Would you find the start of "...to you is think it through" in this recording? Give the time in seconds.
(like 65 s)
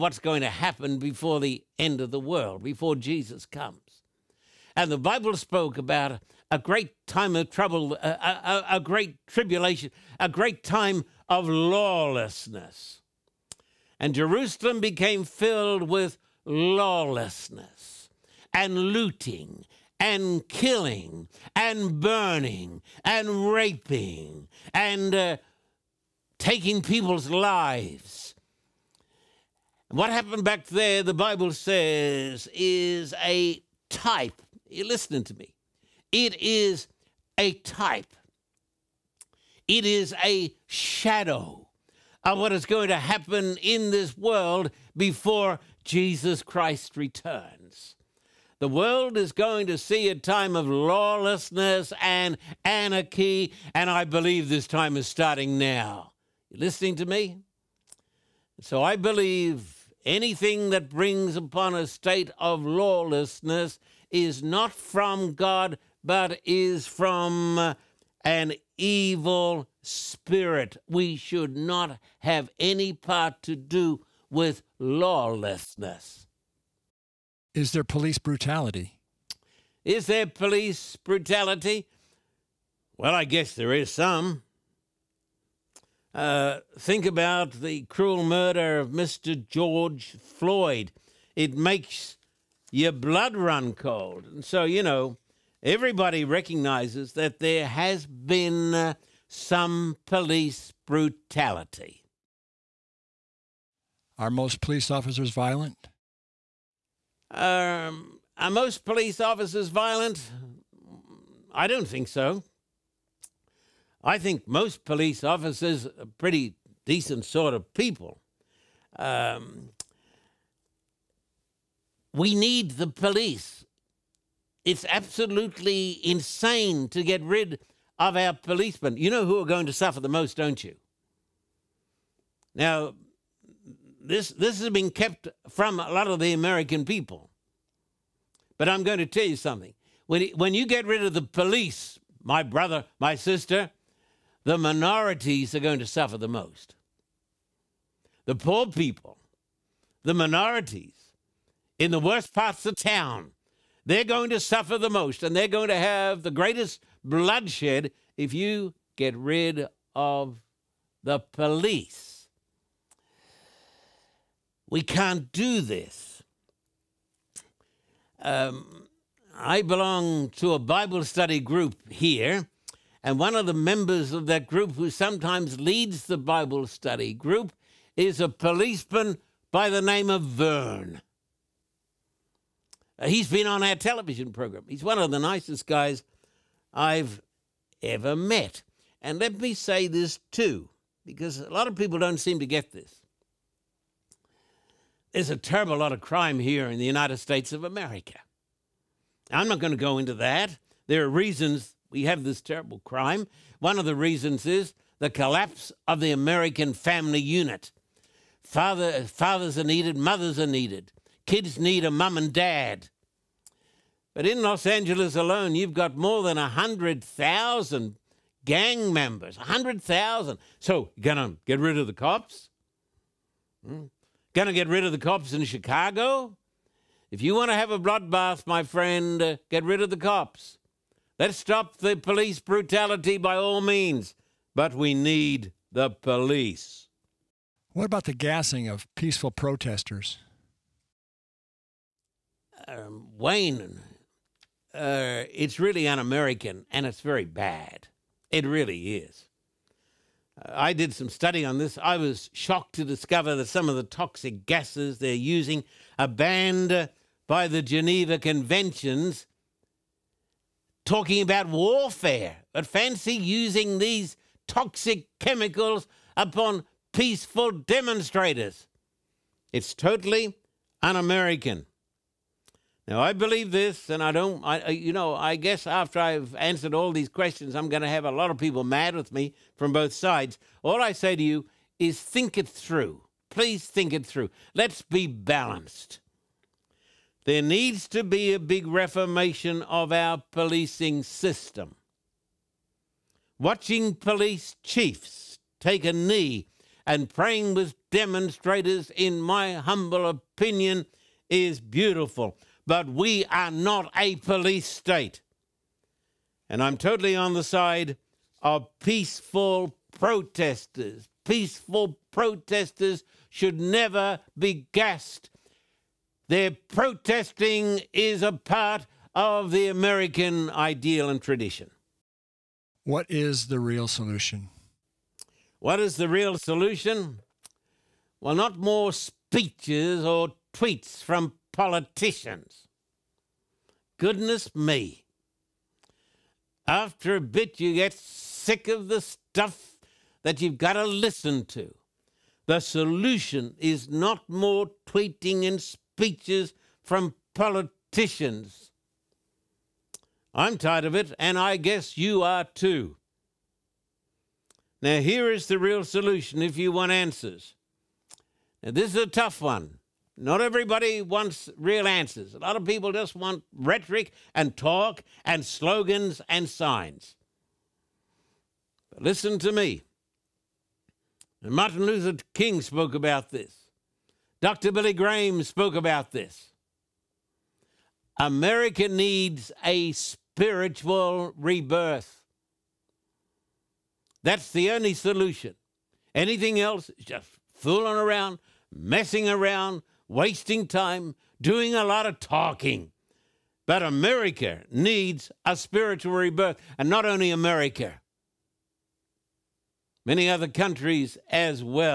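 281 s.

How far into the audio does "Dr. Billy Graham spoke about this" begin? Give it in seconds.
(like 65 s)
374 s.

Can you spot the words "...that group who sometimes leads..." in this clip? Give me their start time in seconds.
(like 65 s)
174 s.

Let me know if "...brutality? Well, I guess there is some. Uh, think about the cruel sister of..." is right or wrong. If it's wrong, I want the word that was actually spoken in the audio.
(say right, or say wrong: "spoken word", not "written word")
wrong: "murder", not "sister".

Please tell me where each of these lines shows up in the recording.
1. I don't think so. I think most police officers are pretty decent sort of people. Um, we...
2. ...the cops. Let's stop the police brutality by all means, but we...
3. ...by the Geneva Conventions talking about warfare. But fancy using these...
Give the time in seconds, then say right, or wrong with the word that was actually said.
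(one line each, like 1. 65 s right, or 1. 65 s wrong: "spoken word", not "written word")
1. 111 s right
2. 229 s right
3. 257 s right.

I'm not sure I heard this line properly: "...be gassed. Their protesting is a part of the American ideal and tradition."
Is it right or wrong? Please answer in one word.
right.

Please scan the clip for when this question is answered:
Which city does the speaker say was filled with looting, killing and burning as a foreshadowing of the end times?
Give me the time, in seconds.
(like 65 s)
14 s.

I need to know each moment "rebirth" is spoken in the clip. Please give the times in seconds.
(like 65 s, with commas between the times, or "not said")
381 s, 396 s.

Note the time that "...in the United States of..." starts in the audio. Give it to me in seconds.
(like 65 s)
196 s.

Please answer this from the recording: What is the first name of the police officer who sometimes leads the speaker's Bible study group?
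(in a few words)
Vern.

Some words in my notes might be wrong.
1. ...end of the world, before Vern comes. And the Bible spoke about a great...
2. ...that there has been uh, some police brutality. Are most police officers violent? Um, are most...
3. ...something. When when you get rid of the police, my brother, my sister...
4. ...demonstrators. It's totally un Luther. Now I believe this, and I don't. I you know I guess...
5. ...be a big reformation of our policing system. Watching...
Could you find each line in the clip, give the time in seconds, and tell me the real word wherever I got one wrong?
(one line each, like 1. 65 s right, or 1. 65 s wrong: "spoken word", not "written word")
1. 1 s wrong: "Jesus", not "Vern"
2. 97 s right
3. 139 s right
4. 267 s wrong: "American", not "Luther"
5. 288 s right.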